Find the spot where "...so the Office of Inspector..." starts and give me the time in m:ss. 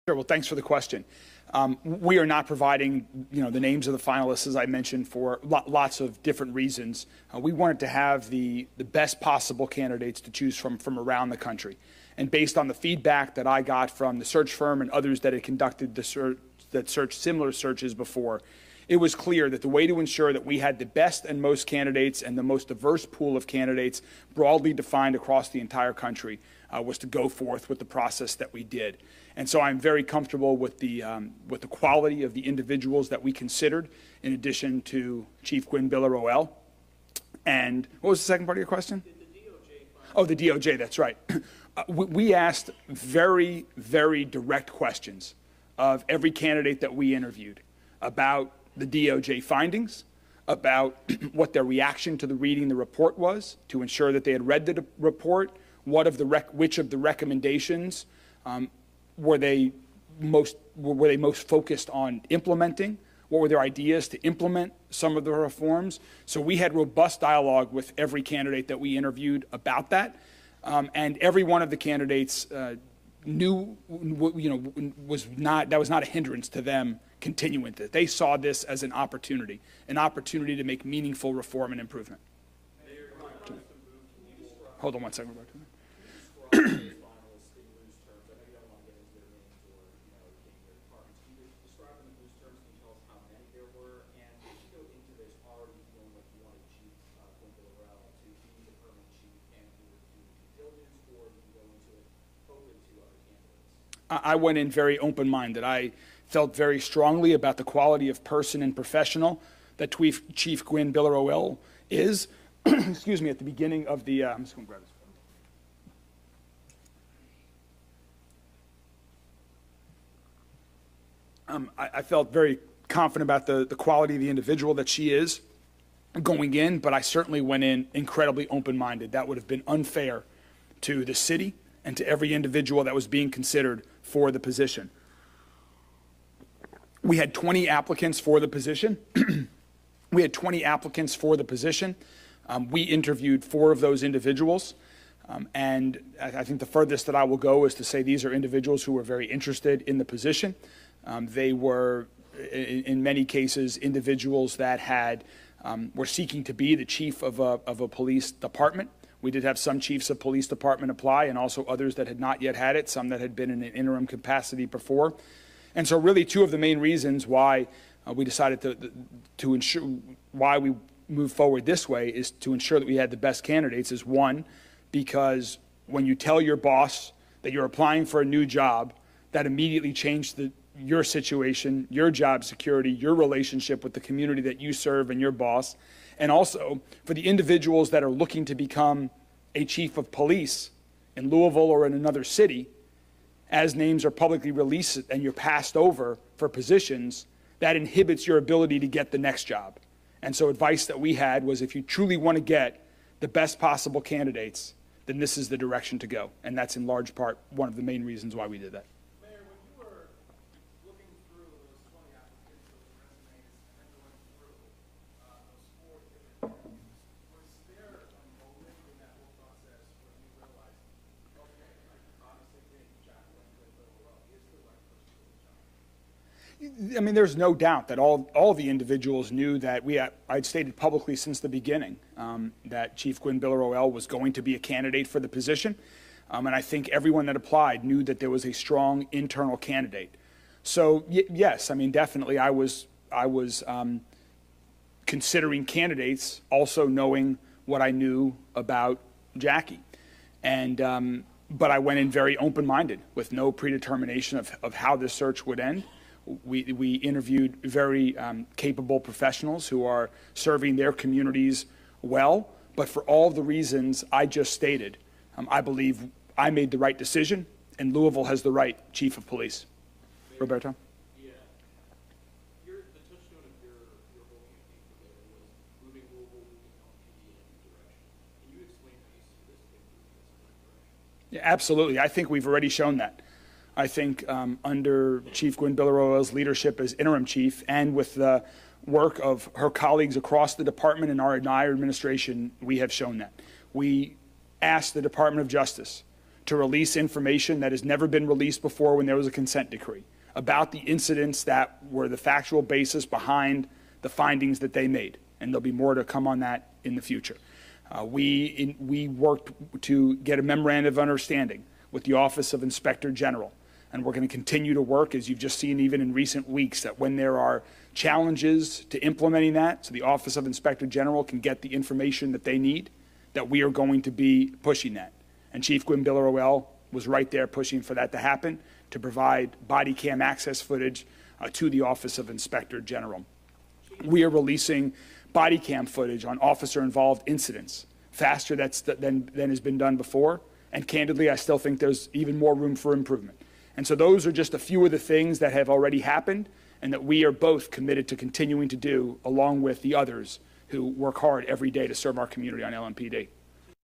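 5:19.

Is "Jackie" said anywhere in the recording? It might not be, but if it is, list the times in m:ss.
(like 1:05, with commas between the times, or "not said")
4:09.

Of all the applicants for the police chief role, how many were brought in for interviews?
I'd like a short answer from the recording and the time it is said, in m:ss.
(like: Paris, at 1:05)
4, at 2:23.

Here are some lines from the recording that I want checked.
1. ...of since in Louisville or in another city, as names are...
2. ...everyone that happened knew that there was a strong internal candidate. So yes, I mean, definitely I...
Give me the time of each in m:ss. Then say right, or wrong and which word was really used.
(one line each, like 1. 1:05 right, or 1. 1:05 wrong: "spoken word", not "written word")
1. 3:09 wrong: "police", not "since"
2. 3:56 wrong: "applied", not "happened".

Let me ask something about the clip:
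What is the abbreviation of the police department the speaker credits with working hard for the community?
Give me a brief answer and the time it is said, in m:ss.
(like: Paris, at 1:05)
LMPD, at 5:52.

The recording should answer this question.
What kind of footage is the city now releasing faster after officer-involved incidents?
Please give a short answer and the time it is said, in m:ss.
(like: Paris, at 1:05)
Body cam footage, at 5:35.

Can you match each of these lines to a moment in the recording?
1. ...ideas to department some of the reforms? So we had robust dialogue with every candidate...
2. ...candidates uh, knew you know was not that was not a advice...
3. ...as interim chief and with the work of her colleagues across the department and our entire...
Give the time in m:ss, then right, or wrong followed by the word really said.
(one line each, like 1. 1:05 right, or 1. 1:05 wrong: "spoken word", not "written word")
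1. 1:03 wrong: "implement", not "department"
2. 1:11 wrong: "hindrance", not "advice"
3. 4:46 right.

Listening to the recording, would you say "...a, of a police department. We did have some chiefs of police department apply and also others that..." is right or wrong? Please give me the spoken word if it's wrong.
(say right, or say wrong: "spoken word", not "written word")
right.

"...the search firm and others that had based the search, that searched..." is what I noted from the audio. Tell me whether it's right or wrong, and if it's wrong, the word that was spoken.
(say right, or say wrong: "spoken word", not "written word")
wrong: "conducted", not "based".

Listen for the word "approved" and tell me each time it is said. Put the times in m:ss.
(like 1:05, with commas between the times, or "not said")
not said.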